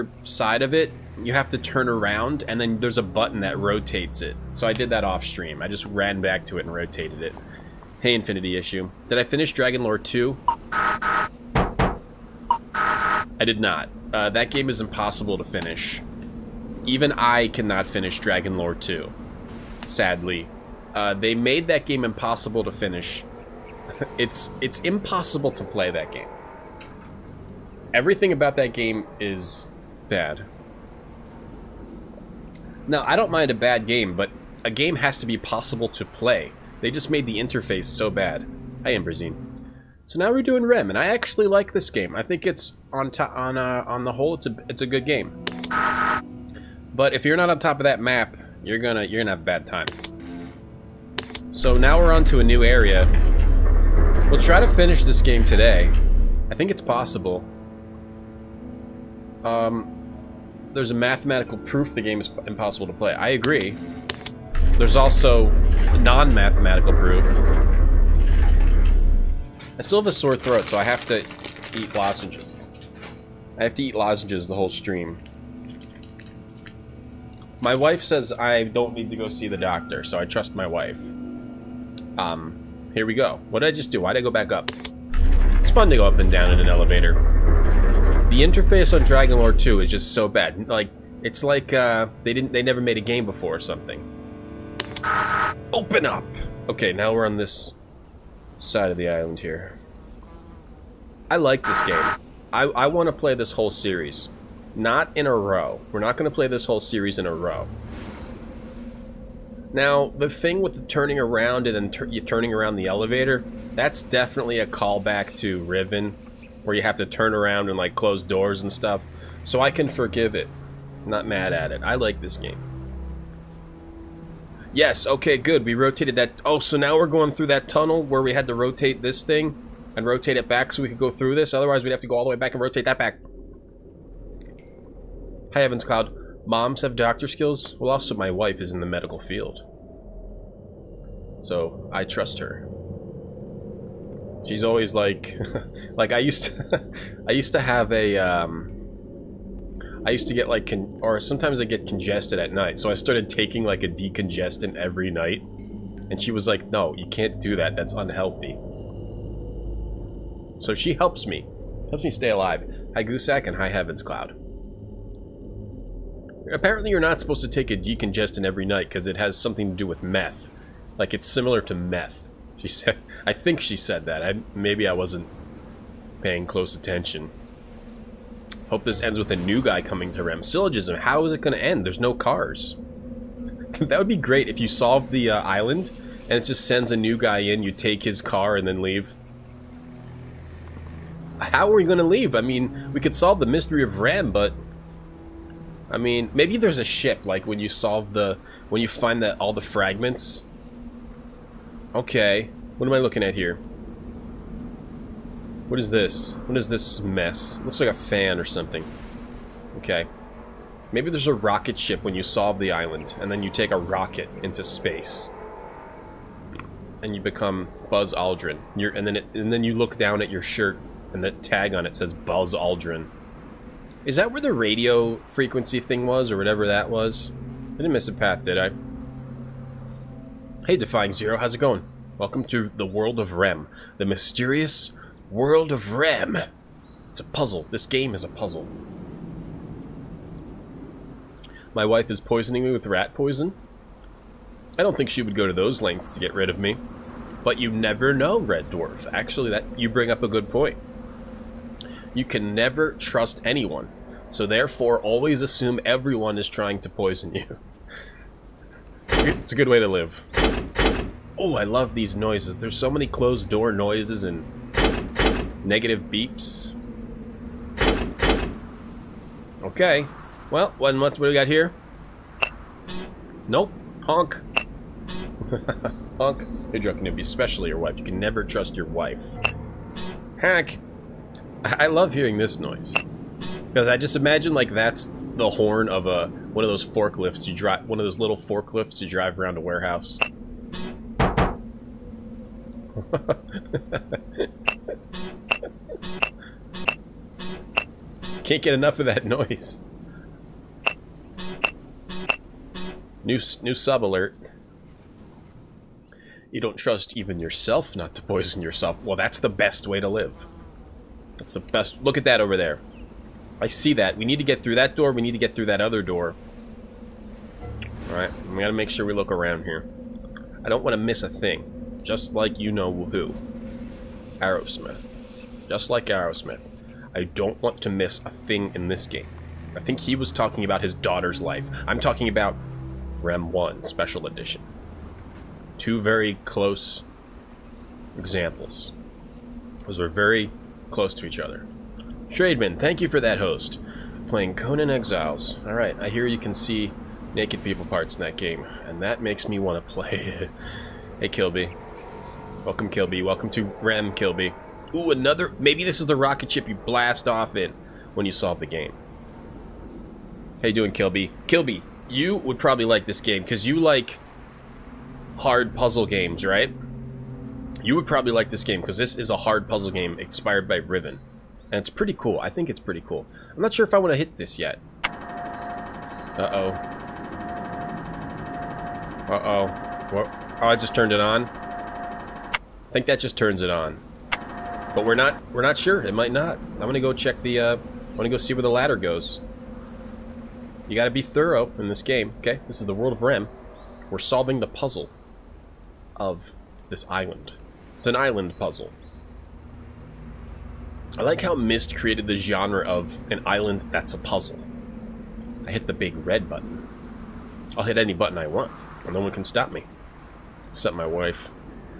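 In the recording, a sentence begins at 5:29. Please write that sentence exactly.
I think he was talking about his daughter's life.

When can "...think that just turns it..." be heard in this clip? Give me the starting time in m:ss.
6:22.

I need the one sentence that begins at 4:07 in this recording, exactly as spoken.
But you never know, Red Dwarf.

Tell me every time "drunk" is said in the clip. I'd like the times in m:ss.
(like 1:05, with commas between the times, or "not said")
4:36.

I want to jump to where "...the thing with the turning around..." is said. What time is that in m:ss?
1:50.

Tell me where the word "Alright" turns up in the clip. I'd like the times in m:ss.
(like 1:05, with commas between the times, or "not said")
5:18, 5:45.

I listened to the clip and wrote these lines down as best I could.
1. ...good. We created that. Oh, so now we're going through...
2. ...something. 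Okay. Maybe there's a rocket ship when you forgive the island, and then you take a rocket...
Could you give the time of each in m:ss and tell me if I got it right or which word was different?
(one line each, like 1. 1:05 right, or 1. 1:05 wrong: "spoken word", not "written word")
1. 2:05 wrong: "rotated", not "created"
2. 3:28 wrong: "solve", not "forgive".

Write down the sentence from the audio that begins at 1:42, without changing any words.
I, I want to play this whole series.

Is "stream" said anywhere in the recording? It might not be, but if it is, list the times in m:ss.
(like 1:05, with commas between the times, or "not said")
0:05, 1:14.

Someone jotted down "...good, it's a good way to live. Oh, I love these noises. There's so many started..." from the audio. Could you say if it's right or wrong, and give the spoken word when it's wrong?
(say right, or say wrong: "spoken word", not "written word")
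wrong: "closed", not "started".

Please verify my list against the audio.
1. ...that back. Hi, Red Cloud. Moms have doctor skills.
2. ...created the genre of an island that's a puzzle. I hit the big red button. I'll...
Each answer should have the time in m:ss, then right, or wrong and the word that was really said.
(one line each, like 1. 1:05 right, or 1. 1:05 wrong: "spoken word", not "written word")
1. 2:12 wrong: "Evans", not "Red"
2. 6:41 right.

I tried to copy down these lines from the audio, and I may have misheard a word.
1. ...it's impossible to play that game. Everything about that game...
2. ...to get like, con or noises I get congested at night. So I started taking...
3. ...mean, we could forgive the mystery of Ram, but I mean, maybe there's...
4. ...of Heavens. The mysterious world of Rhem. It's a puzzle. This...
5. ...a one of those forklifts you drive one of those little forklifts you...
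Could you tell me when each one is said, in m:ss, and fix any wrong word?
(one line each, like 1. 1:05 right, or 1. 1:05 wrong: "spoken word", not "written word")
1. 0:24 right
2. 2:30 wrong: "sometimes", not "noises"
3. 3:12 wrong: "solve", not "forgive"
4. 3:53 wrong: "Rhem", not "Heavens"
5. 4:46 right.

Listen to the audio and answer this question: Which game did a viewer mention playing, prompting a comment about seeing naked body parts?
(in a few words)
Conan Exiles.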